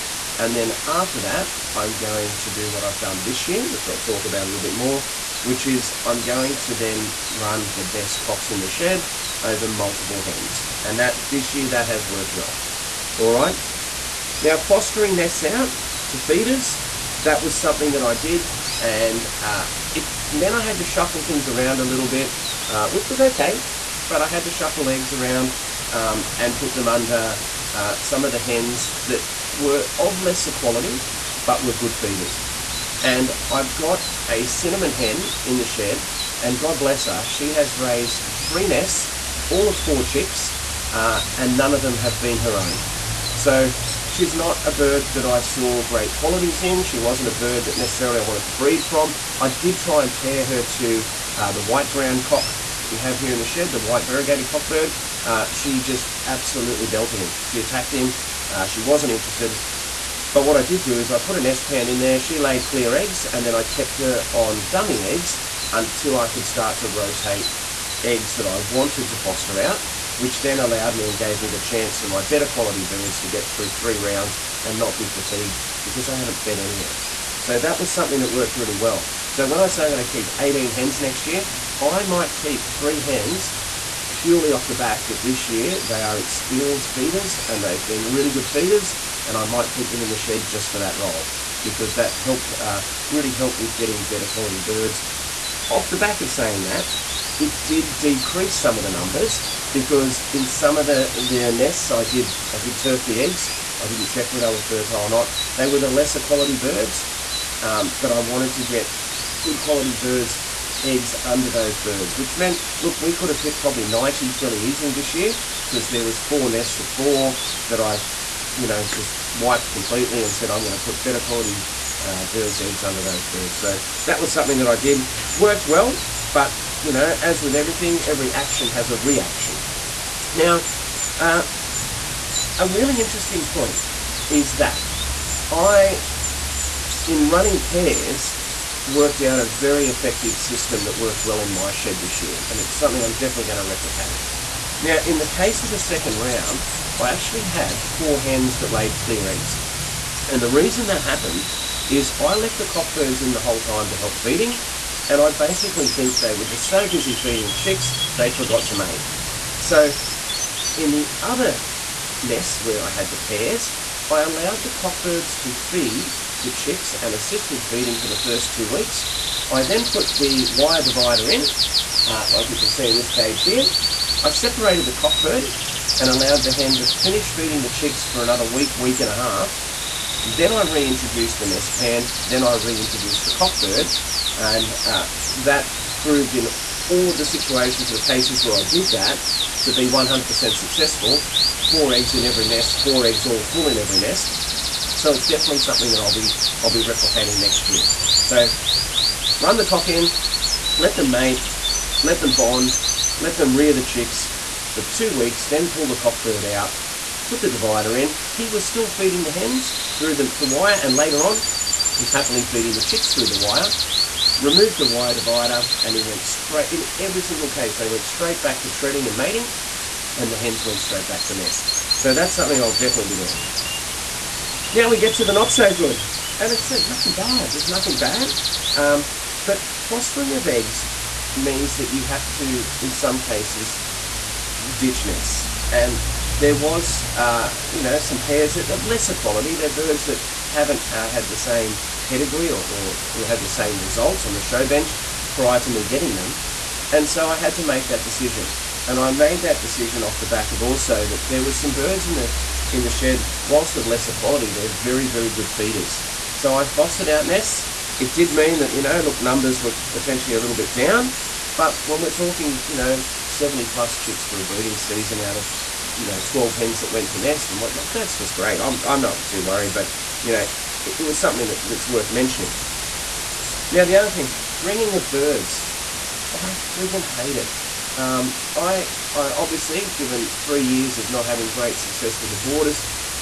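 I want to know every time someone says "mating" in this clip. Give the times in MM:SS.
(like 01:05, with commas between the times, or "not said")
03:39.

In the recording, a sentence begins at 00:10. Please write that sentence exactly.
And that this year that has worked well.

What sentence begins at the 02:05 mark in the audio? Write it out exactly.
Worked well, but, you know, as with everything, every action has a reaction.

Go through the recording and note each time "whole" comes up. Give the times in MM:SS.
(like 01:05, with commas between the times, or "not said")
02:33.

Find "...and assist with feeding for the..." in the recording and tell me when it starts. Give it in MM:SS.
02:46.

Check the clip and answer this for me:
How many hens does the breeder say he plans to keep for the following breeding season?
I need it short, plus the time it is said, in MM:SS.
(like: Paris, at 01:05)
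18, at 01:20.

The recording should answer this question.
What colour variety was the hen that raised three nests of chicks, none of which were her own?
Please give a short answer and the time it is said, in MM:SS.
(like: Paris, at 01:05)
Cinnamon, at 00:34.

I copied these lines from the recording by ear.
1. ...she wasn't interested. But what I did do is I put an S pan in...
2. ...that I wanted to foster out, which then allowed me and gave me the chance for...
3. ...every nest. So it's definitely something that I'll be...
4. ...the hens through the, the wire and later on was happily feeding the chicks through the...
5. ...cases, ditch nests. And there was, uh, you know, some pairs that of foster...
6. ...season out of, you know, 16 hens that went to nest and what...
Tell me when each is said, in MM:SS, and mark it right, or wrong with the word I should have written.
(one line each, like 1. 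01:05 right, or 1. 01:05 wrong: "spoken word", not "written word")
1. 00:58 right
2. 01:08 right
3. 03:13 right
4. 03:29 right
5. 03:53 wrong: "lesser", not "foster"
6. 04:24 wrong: "12", not "16".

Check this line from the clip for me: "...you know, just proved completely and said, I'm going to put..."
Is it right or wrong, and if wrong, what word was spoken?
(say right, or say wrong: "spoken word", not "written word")
wrong: "wiped", not "proved".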